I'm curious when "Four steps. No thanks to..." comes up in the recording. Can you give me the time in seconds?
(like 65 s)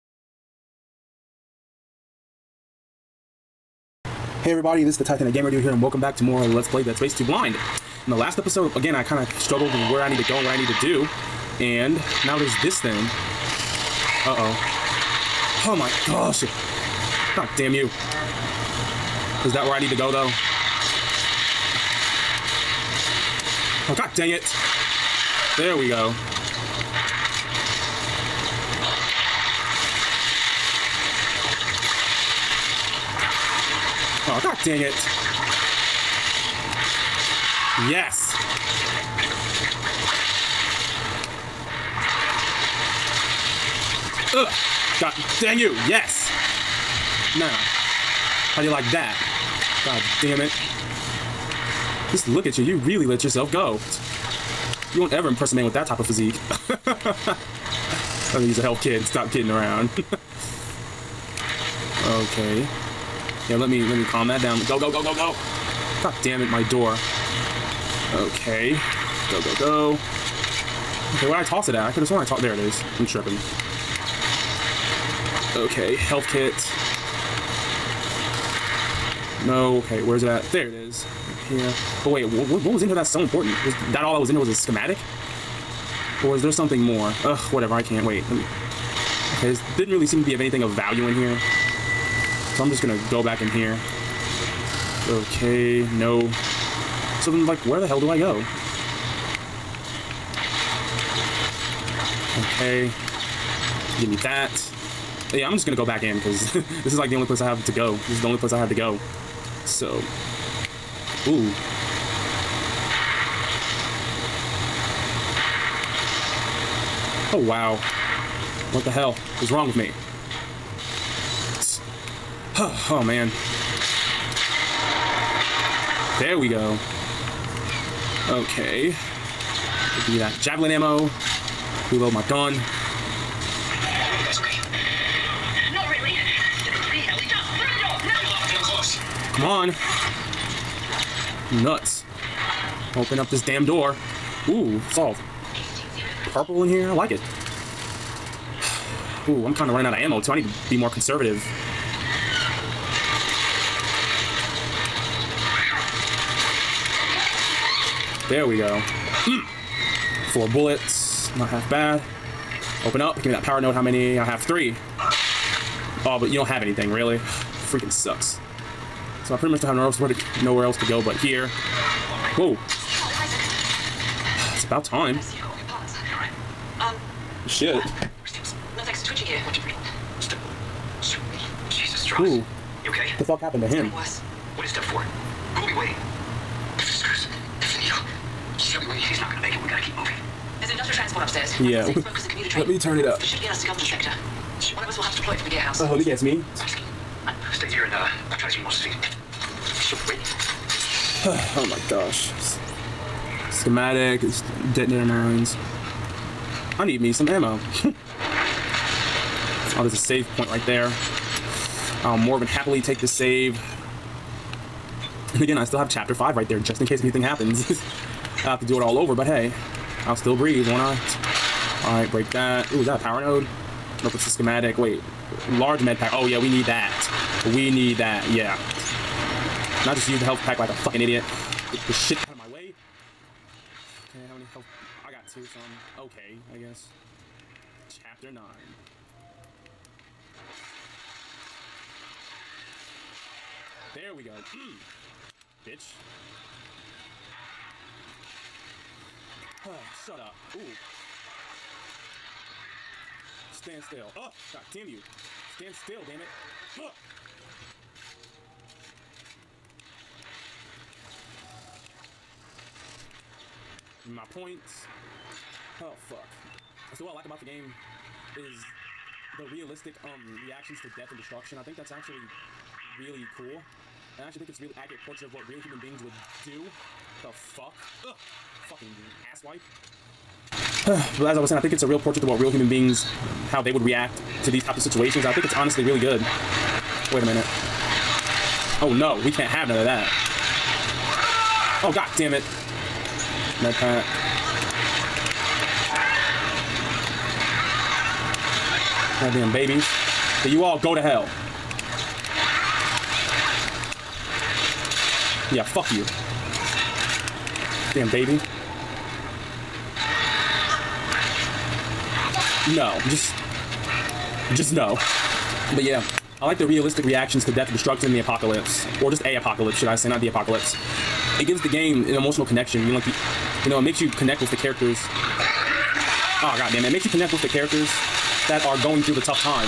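177 s.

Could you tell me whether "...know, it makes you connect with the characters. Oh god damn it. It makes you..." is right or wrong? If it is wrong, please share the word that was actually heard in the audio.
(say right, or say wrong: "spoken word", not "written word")
right.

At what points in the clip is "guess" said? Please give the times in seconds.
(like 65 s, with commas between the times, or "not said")
196 s, 236 s.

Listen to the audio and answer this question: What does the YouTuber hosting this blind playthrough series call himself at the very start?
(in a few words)
Titanic Gamer Dude.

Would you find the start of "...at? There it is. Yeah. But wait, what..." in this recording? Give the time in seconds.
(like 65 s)
80 s.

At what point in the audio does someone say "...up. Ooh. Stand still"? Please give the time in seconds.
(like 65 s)
250 s.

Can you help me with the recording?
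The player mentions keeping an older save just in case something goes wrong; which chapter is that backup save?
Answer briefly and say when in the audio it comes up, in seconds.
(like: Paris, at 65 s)
Chapter 5, at 215 s.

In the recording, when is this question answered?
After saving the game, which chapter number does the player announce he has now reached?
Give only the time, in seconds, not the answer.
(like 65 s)
237 s.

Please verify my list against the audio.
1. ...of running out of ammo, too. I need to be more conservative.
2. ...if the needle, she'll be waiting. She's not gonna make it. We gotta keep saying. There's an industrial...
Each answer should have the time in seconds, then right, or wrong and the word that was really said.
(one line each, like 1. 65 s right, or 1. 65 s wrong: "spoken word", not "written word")
1. 149 s right
2. 187 s wrong: "moving", not "saying".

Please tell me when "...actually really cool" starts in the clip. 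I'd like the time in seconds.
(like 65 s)
271 s.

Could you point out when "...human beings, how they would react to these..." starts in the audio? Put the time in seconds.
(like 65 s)
282 s.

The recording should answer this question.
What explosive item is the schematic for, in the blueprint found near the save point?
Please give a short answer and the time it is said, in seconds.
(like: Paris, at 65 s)
detonator mines, at 204 s.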